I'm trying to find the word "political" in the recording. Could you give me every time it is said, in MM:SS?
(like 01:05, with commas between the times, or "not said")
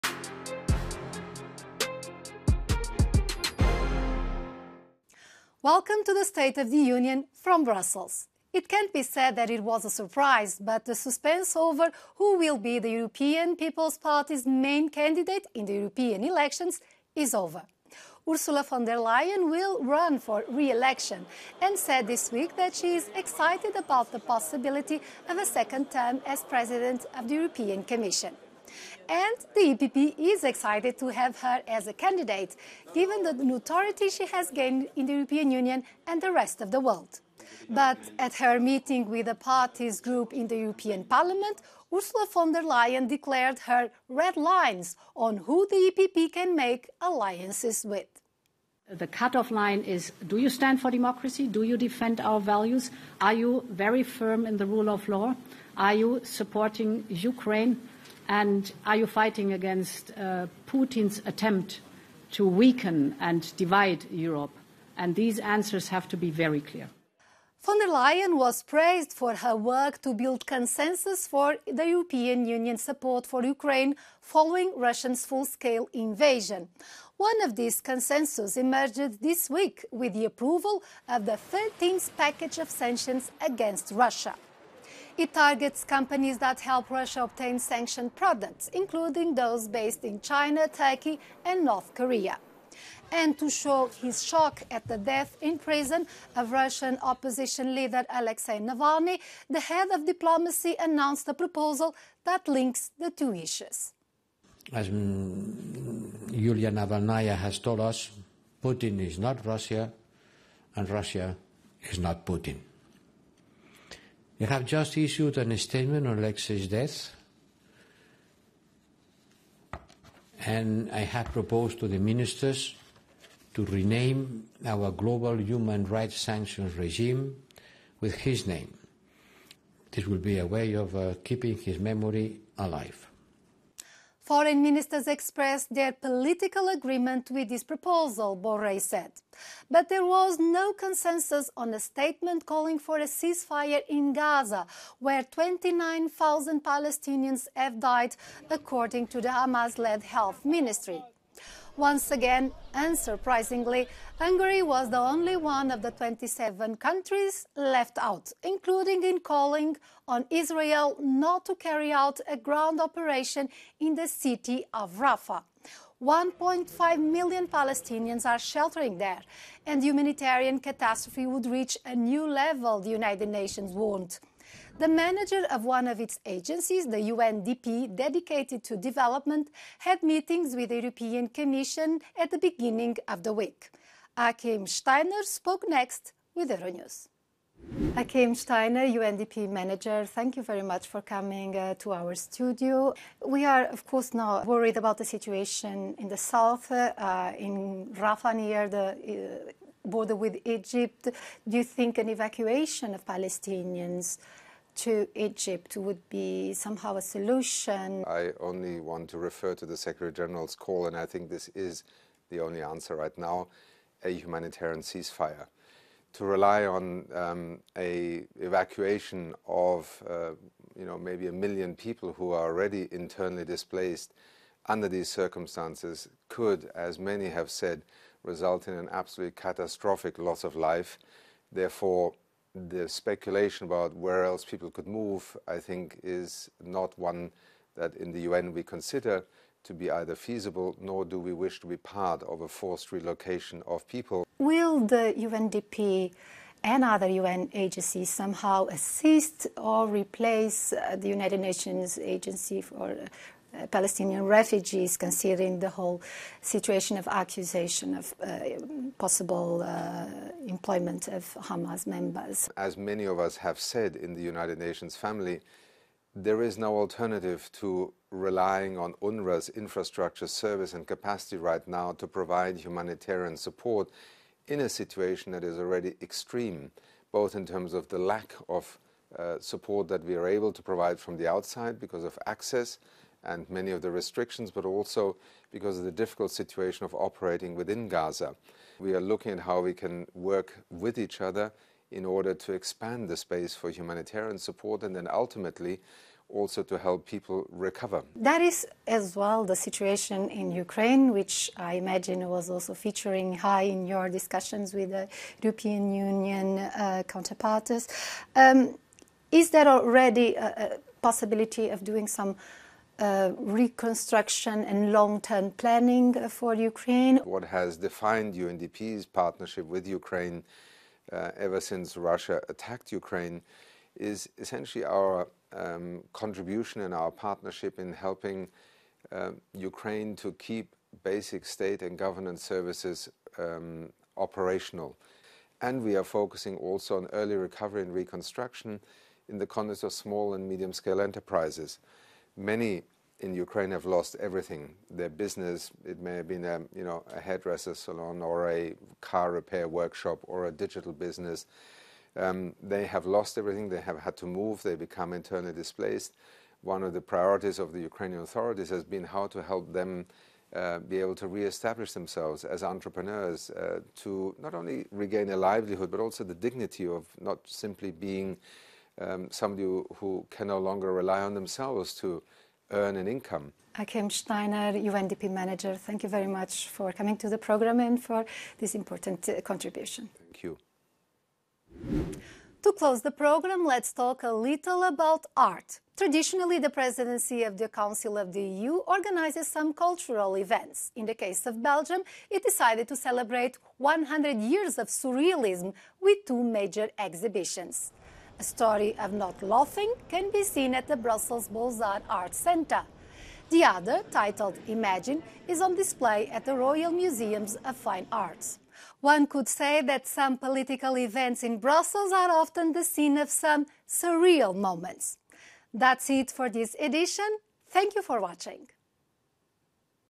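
02:15, 06:50.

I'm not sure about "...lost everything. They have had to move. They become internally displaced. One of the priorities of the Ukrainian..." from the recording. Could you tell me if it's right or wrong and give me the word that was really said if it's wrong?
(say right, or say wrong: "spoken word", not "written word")
right.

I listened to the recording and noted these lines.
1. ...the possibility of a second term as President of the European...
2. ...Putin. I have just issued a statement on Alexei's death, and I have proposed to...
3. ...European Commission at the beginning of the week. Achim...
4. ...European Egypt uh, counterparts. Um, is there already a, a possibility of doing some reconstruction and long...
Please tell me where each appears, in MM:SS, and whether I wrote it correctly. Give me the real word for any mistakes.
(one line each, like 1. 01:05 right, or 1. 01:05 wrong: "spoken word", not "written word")
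1. 00:24 right
2. 01:52 right
3. 03:00 right
4. 05:05 wrong: "Union", not "Egypt".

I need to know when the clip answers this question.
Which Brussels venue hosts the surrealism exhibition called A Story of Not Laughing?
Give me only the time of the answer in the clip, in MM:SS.
06:41.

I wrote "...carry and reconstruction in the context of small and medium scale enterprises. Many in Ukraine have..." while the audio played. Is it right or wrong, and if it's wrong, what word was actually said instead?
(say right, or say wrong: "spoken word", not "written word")
wrong: "recovery", not "carry".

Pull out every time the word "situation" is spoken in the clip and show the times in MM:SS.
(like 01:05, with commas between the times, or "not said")
03:15, 04:16, 04:34, 04:46, 04:59.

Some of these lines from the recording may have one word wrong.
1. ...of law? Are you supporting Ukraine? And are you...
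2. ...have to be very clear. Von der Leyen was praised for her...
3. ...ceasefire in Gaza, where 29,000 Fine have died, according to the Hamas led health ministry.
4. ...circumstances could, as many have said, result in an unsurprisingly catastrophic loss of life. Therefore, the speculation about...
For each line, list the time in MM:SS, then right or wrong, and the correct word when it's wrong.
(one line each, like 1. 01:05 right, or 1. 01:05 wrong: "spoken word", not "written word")
1. 00:54 right
2. 01:05 right
3. 02:23 wrong: "Palestinians", not "Fine"
4. 03:45 wrong: "absolutely", not "unsurprisingly".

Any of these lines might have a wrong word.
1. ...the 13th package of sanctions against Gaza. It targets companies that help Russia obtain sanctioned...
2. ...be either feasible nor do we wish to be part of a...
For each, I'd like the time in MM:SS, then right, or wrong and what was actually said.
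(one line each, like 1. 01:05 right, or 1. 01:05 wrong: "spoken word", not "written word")
1. 01:21 wrong: "Russia", not "Gaza"
2. 03:59 right.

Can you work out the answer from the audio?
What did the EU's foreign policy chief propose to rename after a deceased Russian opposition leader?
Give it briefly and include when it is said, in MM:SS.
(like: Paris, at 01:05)
Global human rights sanctions regime, at 02:04.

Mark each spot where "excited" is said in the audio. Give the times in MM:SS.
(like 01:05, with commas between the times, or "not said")
00:23, 00:30.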